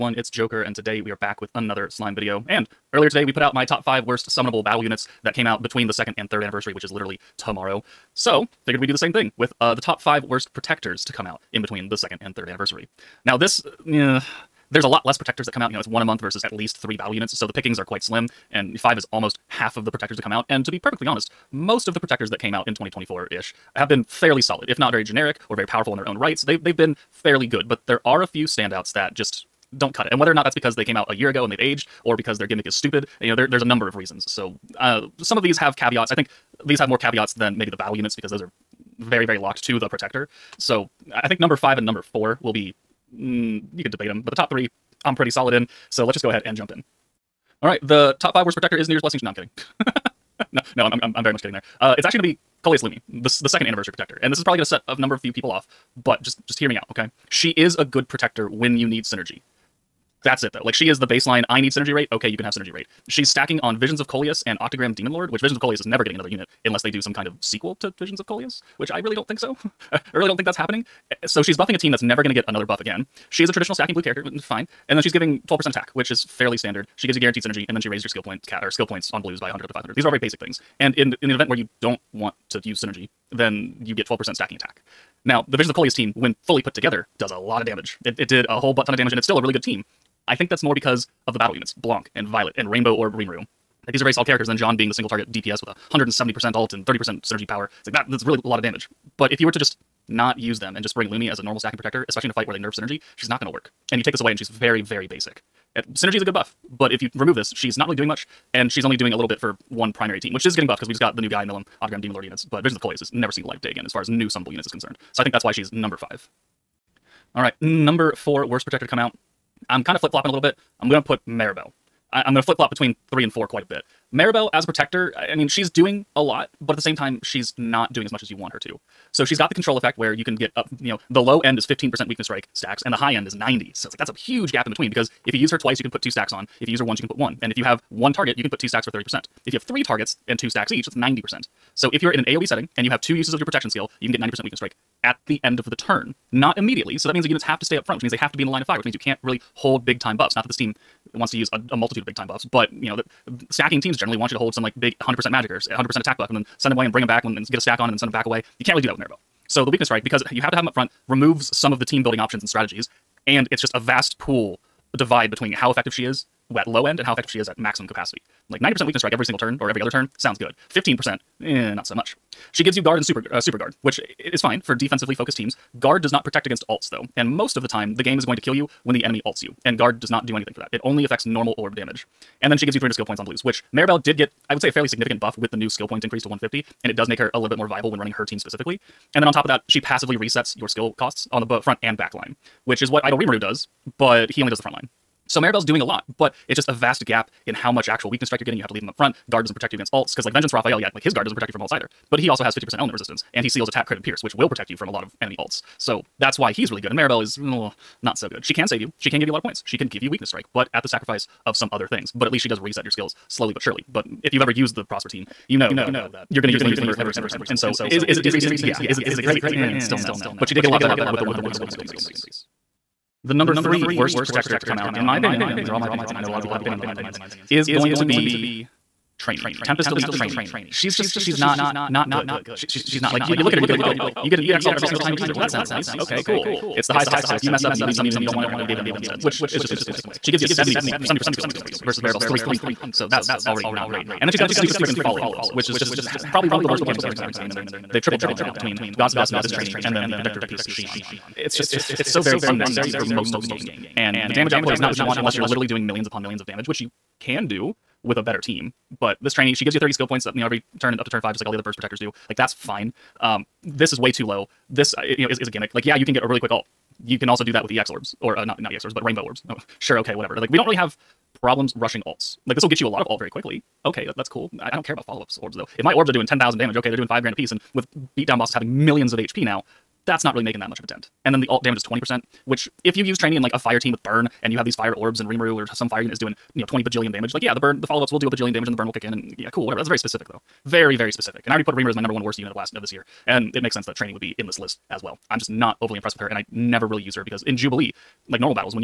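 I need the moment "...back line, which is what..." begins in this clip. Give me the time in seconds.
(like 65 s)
191 s.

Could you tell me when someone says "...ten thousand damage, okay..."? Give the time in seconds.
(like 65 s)
276 s.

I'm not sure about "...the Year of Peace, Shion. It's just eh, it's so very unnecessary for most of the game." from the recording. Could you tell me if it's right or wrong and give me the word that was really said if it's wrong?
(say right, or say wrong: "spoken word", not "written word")
wrong: "Protector", not "Year".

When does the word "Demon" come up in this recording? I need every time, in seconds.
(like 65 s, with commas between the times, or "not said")
64 s, 112 s.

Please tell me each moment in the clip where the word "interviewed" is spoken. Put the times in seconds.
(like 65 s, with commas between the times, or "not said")
not said.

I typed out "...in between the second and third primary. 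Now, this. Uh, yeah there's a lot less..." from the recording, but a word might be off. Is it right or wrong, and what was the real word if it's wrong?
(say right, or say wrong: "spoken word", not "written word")
wrong: "anniversary", not "primary".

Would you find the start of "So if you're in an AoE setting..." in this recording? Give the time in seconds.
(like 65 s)
141 s.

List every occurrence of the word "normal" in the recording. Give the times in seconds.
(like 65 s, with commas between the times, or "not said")
101 s, 181 s.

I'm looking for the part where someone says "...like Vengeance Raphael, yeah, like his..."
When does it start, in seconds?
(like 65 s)
200 s.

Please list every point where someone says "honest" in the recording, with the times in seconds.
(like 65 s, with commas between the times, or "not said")
21 s.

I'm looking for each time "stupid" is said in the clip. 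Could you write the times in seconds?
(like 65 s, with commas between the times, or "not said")
32 s, 244 s.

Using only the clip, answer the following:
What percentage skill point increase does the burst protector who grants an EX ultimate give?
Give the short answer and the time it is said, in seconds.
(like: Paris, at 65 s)
70%, at 241 s.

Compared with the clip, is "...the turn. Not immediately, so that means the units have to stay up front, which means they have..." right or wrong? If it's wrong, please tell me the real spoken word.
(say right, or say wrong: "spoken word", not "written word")
right.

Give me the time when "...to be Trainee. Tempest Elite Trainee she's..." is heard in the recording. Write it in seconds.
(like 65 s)
227 s.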